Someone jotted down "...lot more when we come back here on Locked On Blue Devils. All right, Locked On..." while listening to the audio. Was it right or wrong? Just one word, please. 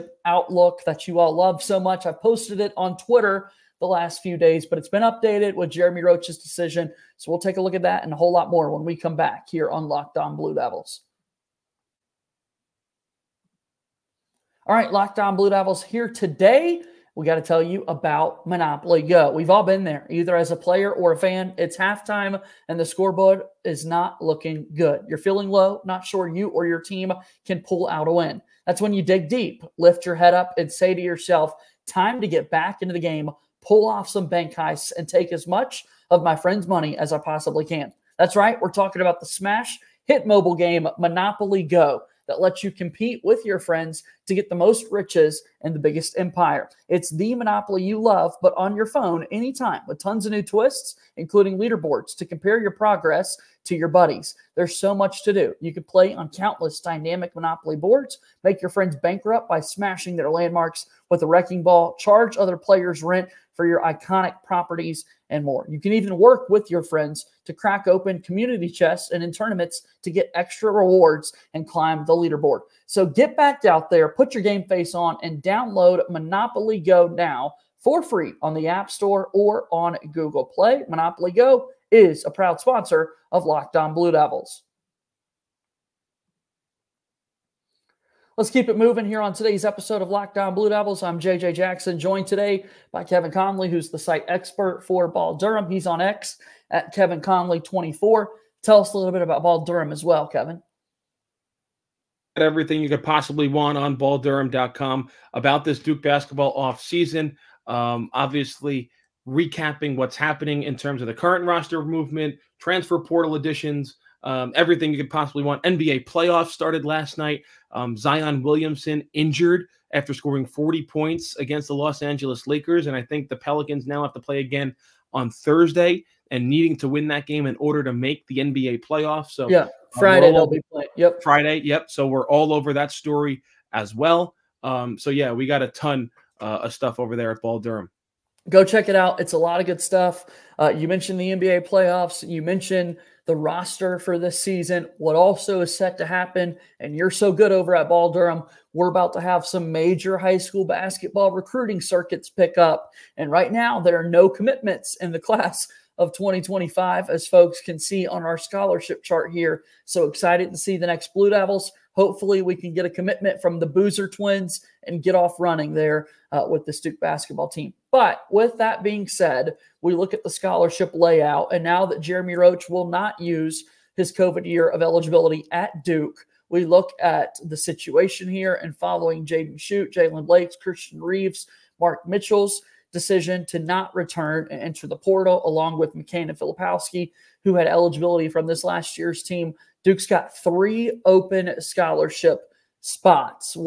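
right.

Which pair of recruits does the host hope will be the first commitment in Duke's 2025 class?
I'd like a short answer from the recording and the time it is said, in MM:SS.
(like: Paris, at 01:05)
The Boozer twins, at 02:43.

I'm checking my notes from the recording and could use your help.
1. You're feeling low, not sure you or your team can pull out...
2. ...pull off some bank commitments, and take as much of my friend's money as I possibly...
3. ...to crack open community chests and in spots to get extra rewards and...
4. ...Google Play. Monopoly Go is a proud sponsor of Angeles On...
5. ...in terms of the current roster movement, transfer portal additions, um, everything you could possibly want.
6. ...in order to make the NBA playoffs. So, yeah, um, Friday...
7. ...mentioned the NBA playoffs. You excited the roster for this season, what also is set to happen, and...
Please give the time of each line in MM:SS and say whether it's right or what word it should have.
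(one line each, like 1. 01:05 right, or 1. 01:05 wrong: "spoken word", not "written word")
1. 00:25 right
2. 00:33 wrong: "heists", not "commitments"
3. 01:07 wrong: "tournaments", not "spots"
4. 01:20 wrong: "Locked", not "Angeles"
5. 01:50 right
6. 02:07 right
7. 02:20 wrong: "mentioned", not "excited".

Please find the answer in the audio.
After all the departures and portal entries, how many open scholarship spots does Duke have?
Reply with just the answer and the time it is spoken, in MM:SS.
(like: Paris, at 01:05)
3, at 03:10.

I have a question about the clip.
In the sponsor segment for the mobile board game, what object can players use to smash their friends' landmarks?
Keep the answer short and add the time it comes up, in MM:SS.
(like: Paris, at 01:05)
Wrecking ball, at 01:01.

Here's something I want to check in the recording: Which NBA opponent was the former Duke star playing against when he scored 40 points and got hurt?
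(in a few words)
Los Angeles Lakers.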